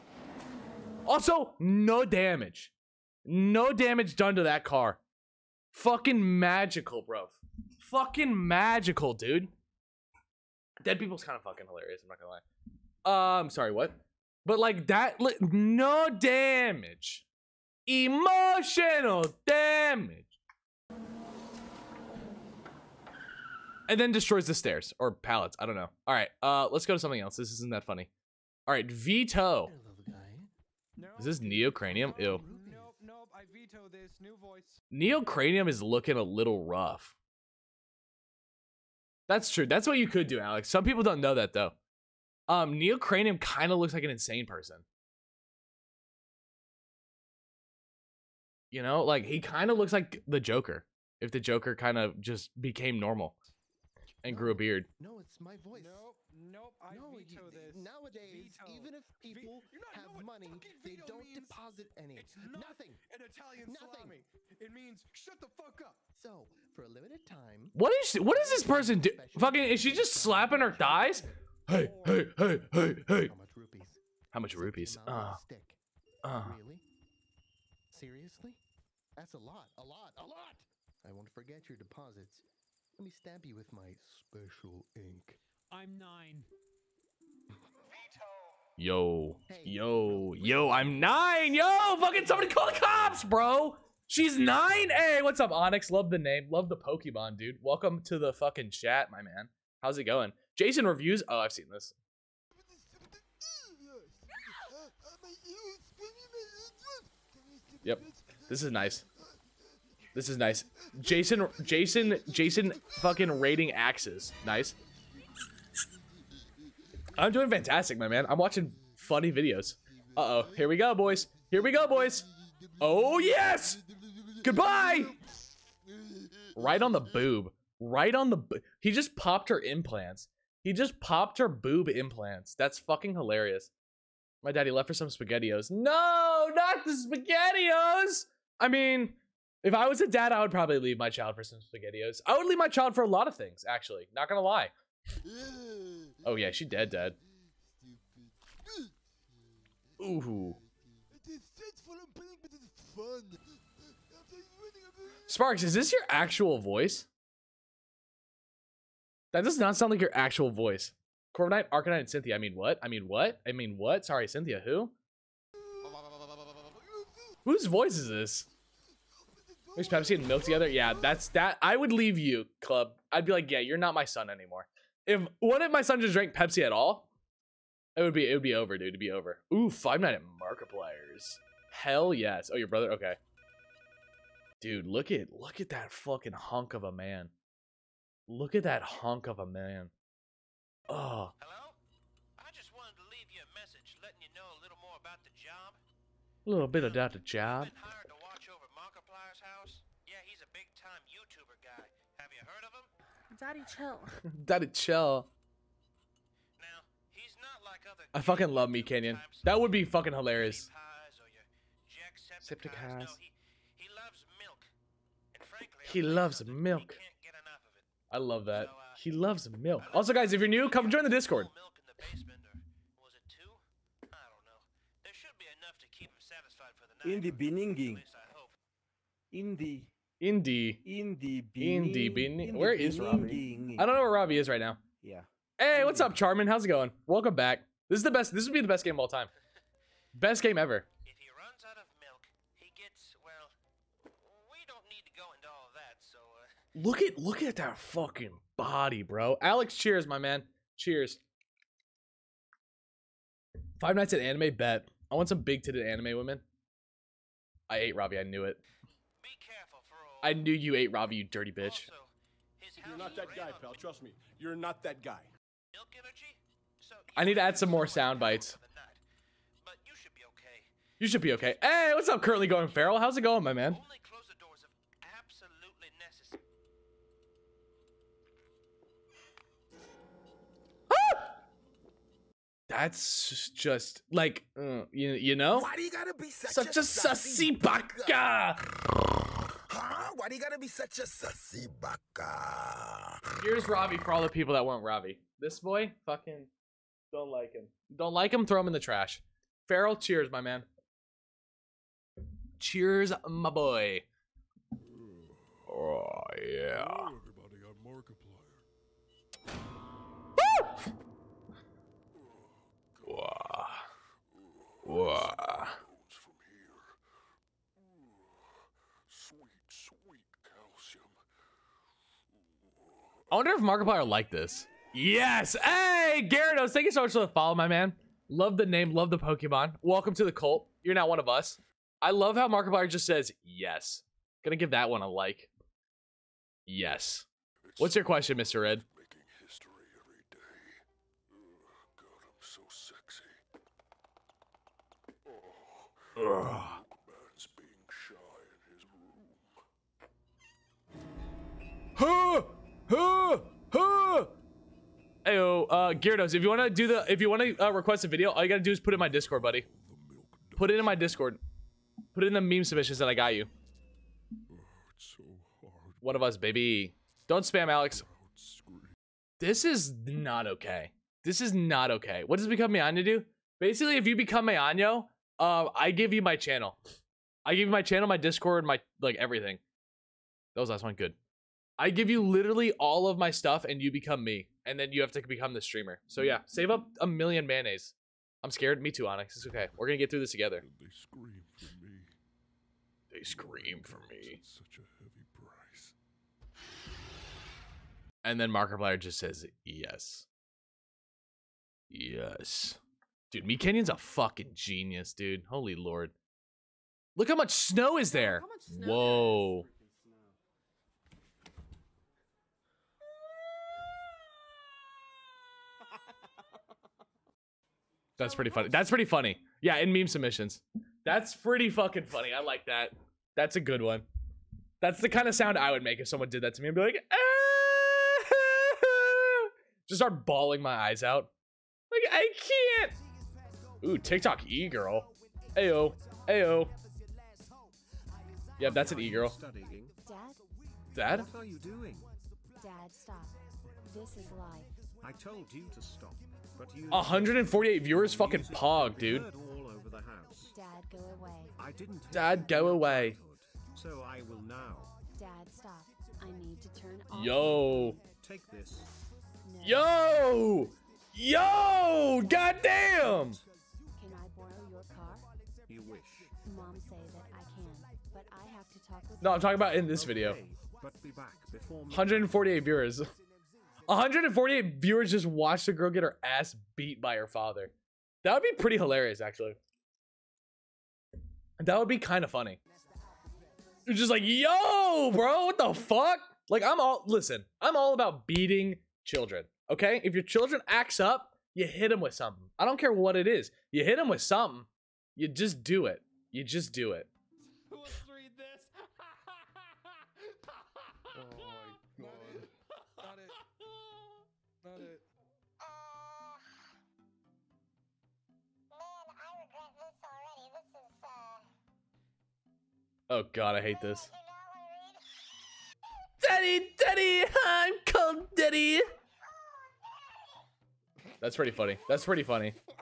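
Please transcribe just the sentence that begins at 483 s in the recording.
You're just like, yo, bro, what the fuck?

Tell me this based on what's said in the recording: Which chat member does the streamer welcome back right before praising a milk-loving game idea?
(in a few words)
Charmin.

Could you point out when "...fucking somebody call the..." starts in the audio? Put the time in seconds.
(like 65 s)
91 s.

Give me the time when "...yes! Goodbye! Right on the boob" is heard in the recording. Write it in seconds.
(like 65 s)
123 s.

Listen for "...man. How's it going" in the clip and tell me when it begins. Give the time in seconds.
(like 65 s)
99 s.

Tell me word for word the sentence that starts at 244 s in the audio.
We don't need to go into all that.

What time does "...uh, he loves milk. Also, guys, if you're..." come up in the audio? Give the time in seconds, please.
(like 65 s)
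218 s.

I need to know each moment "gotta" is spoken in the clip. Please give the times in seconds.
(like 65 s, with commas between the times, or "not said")
285 s, 290 s.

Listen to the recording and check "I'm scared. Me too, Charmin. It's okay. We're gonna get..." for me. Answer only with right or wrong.
wrong.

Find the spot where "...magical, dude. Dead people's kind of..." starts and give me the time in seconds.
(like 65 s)
8 s.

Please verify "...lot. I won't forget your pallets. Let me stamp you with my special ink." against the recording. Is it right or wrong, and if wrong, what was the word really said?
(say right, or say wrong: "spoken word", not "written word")
wrong: "deposits", not "pallets".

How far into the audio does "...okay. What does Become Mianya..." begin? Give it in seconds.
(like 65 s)
371 s.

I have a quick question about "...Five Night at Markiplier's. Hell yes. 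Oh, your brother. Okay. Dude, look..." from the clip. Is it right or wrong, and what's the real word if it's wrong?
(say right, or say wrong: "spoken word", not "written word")
right.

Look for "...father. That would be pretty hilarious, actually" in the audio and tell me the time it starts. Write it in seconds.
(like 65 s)
477 s.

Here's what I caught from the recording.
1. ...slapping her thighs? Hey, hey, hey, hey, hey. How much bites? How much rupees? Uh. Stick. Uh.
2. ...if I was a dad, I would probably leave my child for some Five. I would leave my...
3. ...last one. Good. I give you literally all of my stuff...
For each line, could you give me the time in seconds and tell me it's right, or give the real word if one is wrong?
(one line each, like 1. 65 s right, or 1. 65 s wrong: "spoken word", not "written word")
1. 70 s wrong: "rupees", not "bites"
2. 139 s wrong: "SpaghettiOs", not "Five"
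3. 380 s right.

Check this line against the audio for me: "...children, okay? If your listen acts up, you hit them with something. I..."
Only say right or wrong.
wrong.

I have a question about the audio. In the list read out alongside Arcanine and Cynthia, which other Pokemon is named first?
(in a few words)
Corviknight.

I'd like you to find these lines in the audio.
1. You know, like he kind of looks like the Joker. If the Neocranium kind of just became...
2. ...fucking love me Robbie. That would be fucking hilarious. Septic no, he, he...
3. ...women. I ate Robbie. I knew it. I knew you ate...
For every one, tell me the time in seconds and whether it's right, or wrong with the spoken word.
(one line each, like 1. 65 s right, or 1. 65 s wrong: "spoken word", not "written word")
1. 48 s wrong: "Joker", not "Neocranium"
2. 208 s wrong: "Kenyon", not "Robbie"
3. 256 s right.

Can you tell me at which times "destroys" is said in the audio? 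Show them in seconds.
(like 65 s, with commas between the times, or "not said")
24 s.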